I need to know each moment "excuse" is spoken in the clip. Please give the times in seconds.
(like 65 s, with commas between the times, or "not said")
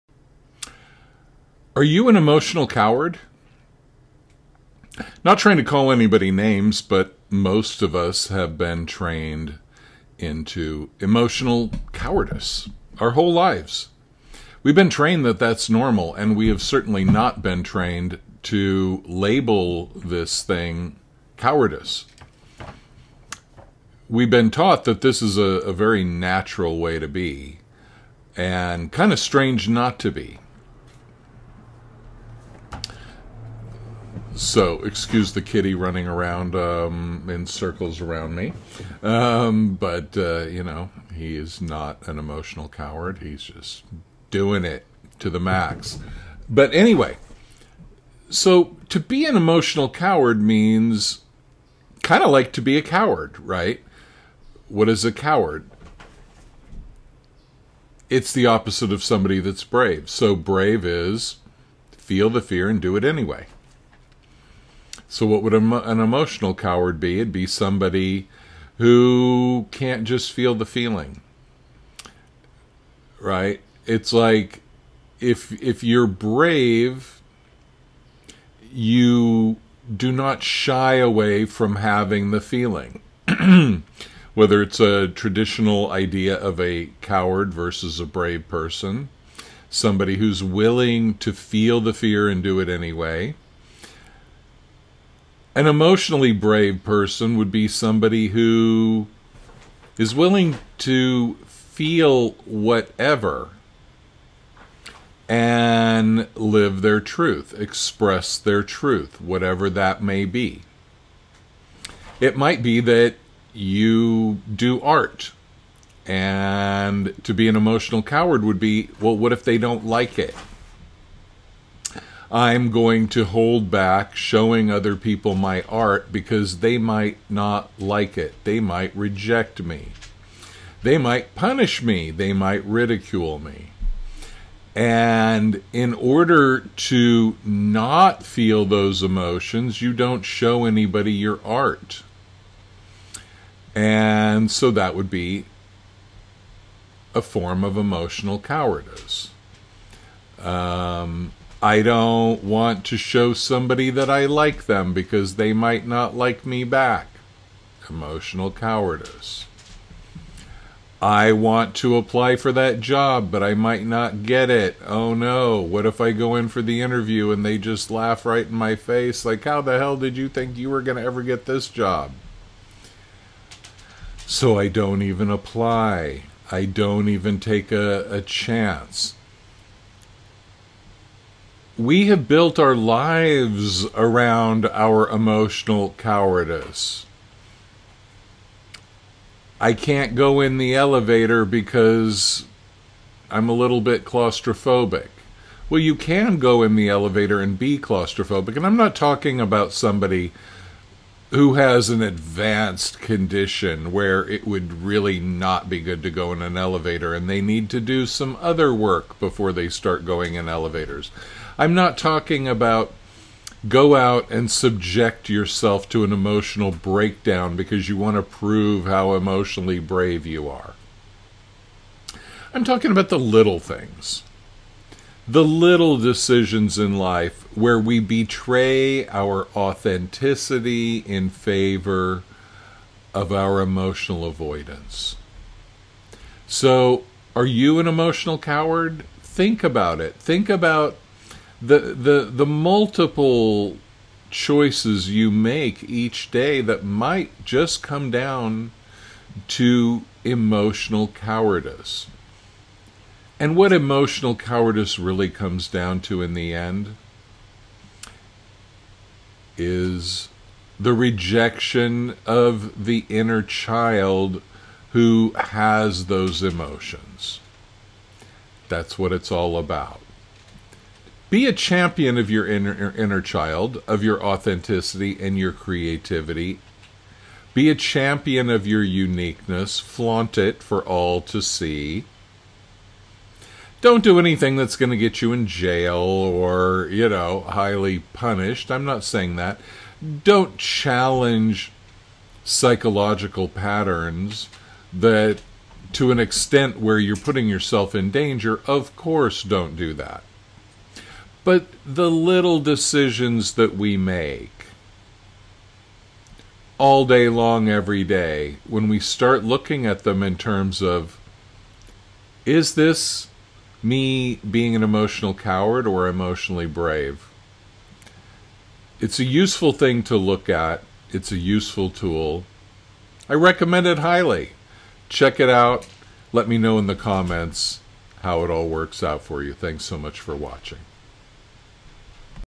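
34 s.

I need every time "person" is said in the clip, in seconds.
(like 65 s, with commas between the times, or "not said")
88 s, 96 s.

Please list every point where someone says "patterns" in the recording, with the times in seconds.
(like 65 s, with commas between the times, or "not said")
293 s.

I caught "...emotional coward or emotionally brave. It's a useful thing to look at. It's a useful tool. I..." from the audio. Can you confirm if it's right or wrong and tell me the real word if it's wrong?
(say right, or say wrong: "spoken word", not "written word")
right.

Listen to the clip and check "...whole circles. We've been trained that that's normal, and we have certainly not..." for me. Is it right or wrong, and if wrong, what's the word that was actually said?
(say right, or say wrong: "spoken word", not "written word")
wrong: "lives", not "circles".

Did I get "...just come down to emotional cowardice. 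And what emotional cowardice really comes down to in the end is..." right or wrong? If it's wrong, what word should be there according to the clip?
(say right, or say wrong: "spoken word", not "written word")
right.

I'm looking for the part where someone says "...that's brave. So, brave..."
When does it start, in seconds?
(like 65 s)
59 s.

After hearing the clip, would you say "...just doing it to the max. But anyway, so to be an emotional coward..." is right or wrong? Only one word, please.
right.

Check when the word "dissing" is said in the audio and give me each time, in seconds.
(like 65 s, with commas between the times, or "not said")
not said.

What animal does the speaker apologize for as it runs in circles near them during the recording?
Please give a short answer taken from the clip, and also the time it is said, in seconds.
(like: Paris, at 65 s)
kitty, at 35 s.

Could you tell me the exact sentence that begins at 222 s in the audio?
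I'm talking about the little things the little decisions in life where we betray our authenticity in favor of our emotional avoidance.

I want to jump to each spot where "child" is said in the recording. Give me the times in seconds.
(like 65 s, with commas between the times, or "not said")
263 s, 273 s.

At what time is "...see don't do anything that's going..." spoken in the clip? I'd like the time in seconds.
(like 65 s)
281 s.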